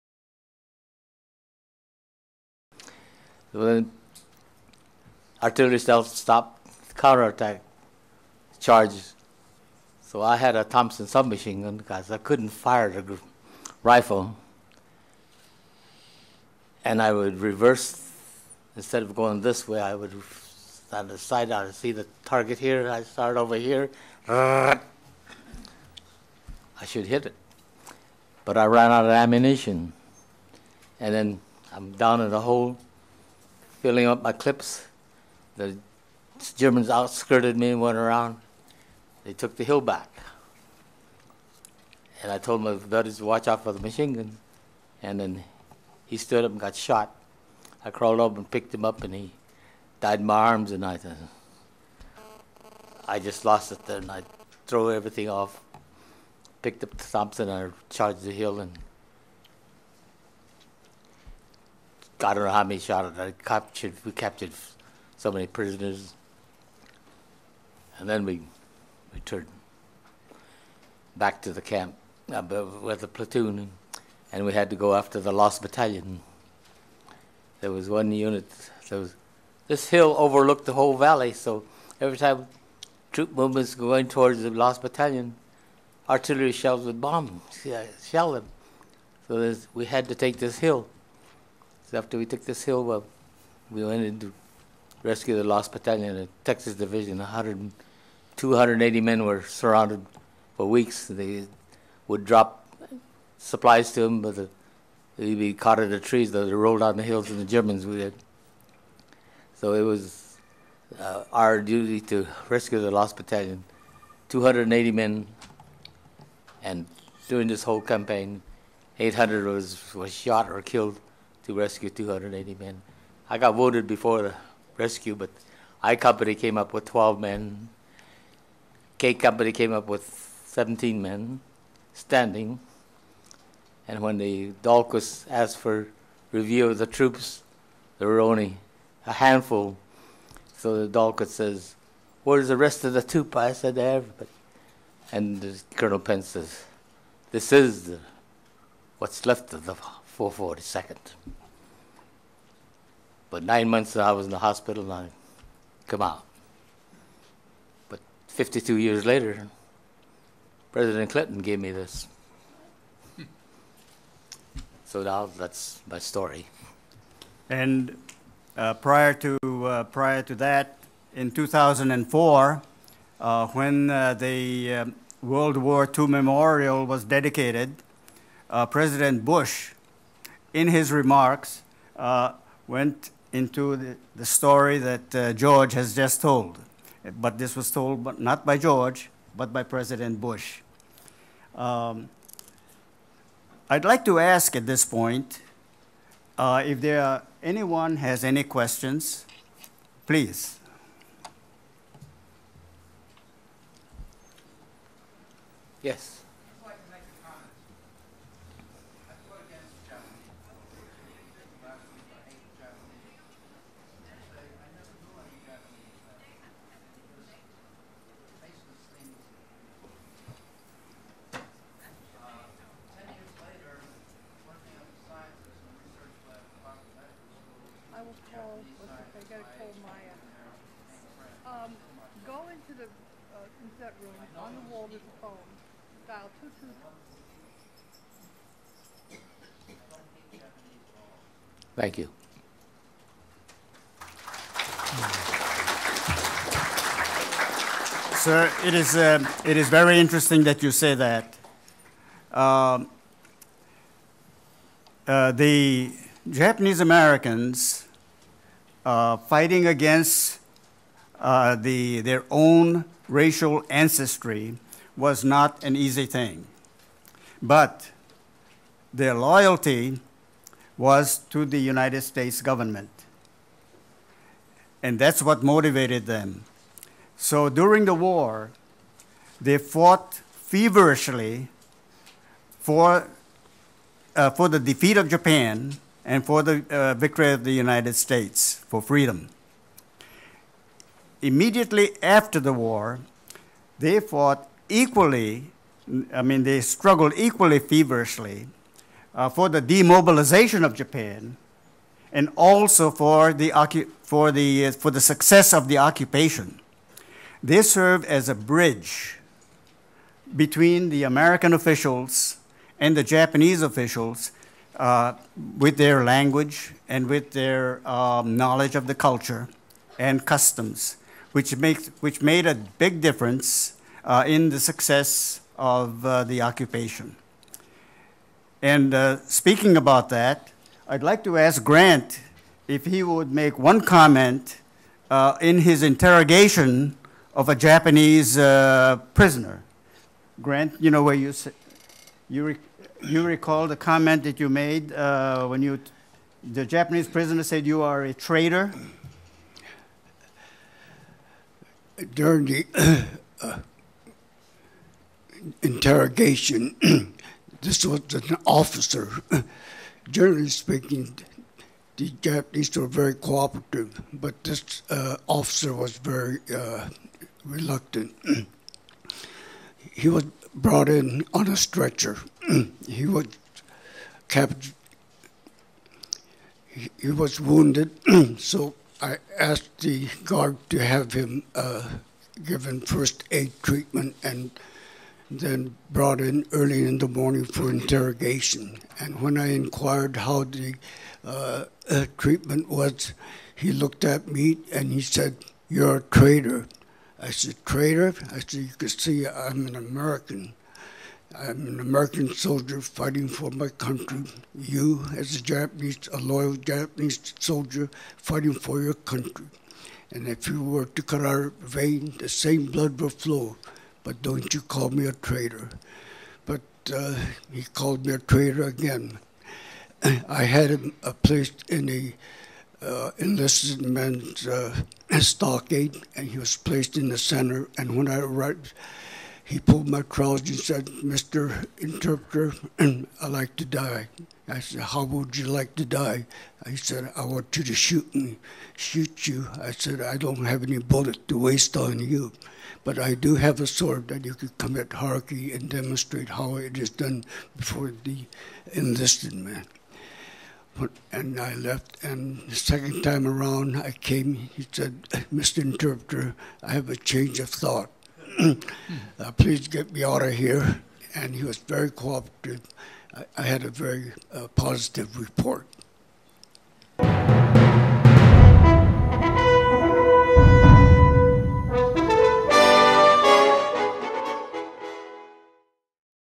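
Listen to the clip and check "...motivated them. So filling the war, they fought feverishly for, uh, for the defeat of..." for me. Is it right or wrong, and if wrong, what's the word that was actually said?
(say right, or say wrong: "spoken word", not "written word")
wrong: "during", not "filling".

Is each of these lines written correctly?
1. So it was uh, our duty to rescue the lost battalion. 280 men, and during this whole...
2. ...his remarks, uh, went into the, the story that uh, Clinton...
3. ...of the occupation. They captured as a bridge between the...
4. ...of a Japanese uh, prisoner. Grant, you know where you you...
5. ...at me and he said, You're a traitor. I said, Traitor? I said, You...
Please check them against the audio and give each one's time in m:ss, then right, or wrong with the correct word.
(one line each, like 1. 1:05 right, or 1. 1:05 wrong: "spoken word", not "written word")
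1. 1:49 right
2. 3:00 wrong: "George", not "Clinton"
3. 5:05 wrong: "served", not "captured"
4. 5:37 right
5. 6:34 right.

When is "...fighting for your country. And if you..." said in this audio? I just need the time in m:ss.
6:48.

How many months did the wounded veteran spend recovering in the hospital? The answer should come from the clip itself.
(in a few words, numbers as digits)
9.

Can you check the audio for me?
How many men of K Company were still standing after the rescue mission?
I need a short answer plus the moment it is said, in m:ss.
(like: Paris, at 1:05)
17, at 2:10.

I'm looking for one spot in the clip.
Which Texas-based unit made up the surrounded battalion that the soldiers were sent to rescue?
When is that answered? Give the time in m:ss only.
1:36.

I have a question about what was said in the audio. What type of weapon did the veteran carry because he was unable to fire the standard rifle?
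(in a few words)
Thompson submachine gun.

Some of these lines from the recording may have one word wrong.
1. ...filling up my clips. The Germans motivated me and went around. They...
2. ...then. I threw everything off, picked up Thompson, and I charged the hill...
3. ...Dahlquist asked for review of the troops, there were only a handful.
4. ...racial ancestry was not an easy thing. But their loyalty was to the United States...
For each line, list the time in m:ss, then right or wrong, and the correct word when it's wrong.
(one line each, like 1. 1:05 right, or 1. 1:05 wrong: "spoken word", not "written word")
1. 0:33 wrong: "outskirted", not "motivated"
2. 0:53 right
3. 2:14 right
4. 4:23 right.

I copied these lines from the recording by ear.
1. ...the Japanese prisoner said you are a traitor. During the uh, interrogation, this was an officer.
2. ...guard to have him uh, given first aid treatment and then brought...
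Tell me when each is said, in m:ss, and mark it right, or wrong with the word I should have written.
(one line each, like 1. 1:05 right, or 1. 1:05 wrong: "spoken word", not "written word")
1. 5:46 right
2. 6:20 right.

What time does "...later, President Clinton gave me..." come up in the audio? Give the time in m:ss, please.
2:39.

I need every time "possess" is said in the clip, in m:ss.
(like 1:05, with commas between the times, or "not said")
not said.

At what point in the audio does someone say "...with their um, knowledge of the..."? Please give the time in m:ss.
5:17.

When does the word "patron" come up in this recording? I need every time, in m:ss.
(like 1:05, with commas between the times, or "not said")
not said.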